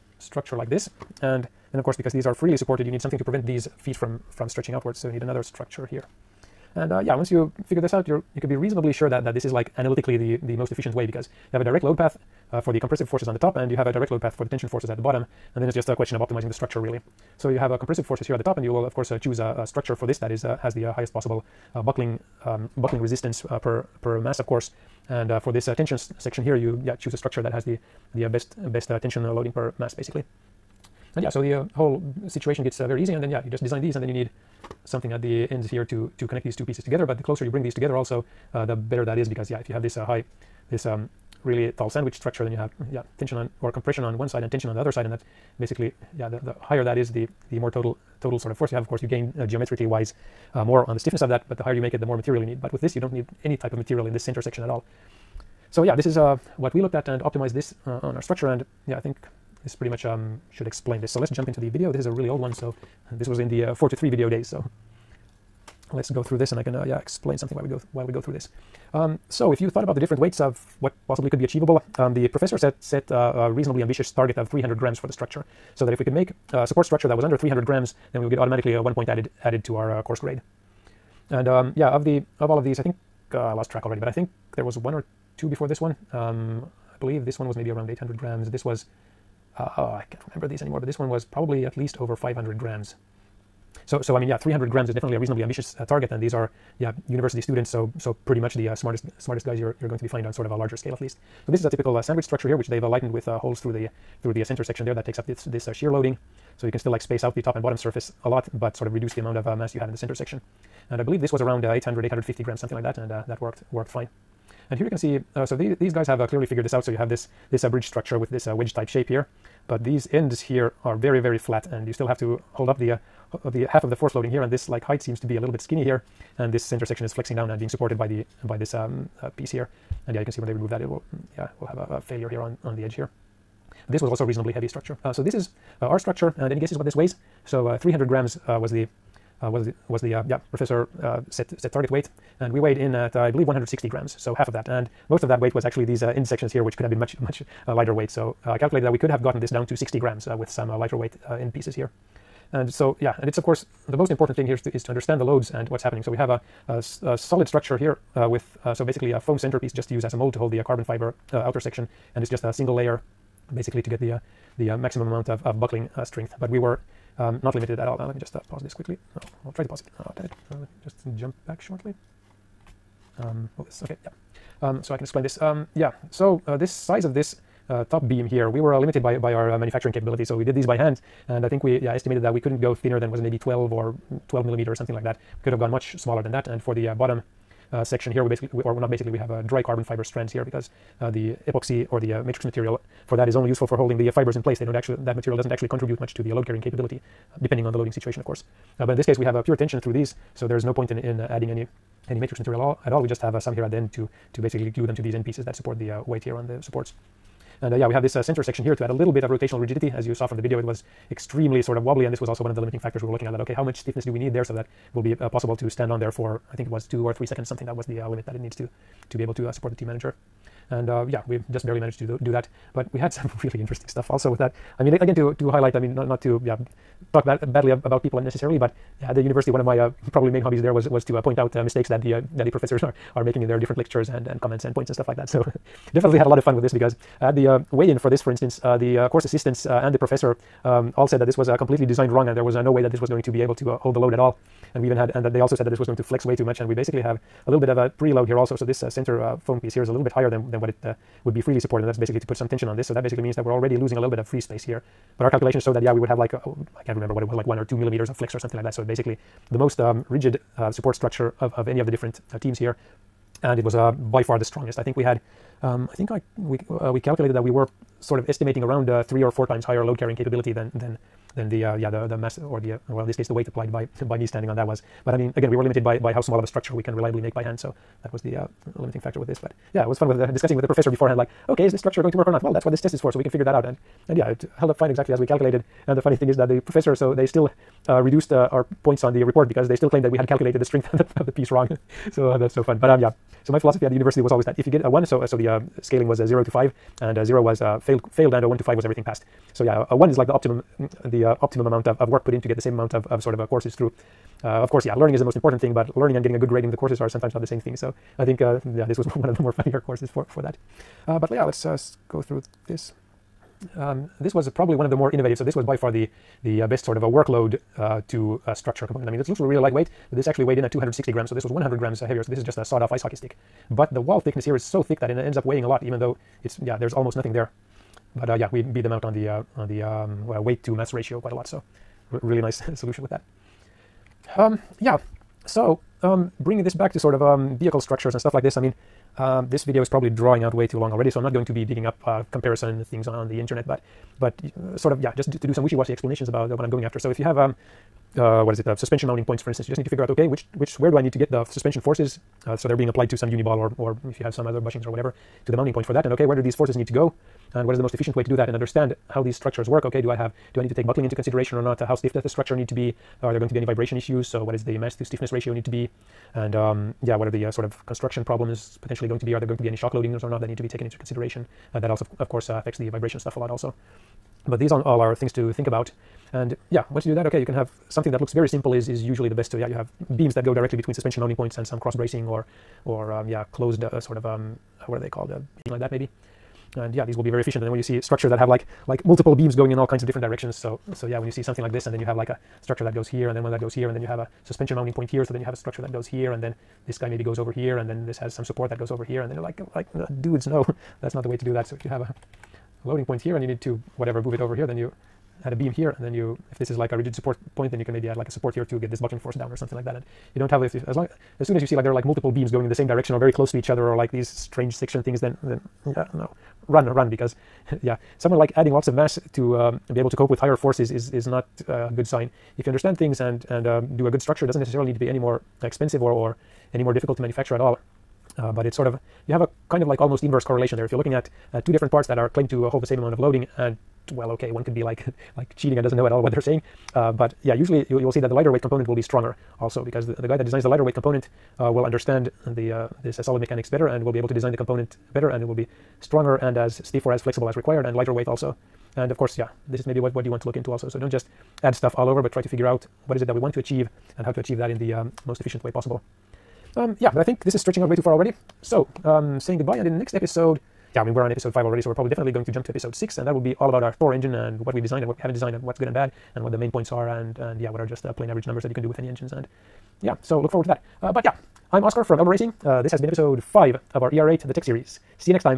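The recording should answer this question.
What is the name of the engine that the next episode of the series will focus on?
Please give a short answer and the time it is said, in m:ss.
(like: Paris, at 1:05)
Thor, at 7:44.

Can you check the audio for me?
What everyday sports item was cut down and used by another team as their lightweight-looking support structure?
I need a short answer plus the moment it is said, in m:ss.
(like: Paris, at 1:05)
ice hockey stick, at 5:22.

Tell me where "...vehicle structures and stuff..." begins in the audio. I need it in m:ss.
5:37.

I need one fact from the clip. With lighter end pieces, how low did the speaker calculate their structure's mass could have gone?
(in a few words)
60 grams.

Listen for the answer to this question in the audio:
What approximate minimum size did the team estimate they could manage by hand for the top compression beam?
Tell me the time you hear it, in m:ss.
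3:04.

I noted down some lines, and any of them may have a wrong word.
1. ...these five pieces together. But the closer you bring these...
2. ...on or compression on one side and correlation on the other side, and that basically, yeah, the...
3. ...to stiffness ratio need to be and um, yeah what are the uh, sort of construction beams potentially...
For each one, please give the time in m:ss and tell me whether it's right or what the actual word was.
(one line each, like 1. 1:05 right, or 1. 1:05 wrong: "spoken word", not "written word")
1. 0:36 wrong: "two", not "five"
2. 0:43 wrong: "tension", not "correlation"
3. 6:04 wrong: "problems", not "beams".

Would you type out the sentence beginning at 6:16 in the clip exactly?
And yeah, once you do that, okay, you can have something that looks very simple is, is usually the best.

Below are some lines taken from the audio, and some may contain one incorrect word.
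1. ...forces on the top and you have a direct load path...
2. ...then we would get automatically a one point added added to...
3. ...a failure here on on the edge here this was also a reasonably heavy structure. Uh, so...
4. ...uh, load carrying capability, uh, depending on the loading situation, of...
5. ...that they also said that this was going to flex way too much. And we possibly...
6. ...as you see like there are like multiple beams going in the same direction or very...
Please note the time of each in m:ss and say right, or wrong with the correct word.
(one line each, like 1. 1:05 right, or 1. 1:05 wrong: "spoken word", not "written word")
1. 0:13 right
2. 1:18 right
3. 2:11 right
4. 3:16 right
5. 4:05 wrong: "basically", not "possibly"
6. 6:51 right.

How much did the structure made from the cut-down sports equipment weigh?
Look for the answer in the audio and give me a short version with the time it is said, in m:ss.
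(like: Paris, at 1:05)
260 grams, at 5:20.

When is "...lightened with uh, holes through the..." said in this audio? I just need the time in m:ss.
1:42.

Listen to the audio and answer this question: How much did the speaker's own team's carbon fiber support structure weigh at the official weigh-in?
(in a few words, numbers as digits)
160 grams.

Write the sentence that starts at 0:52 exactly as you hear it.
But with this, you don't need any type of material in this center section at all.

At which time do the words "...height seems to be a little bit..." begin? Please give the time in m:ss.
2:04.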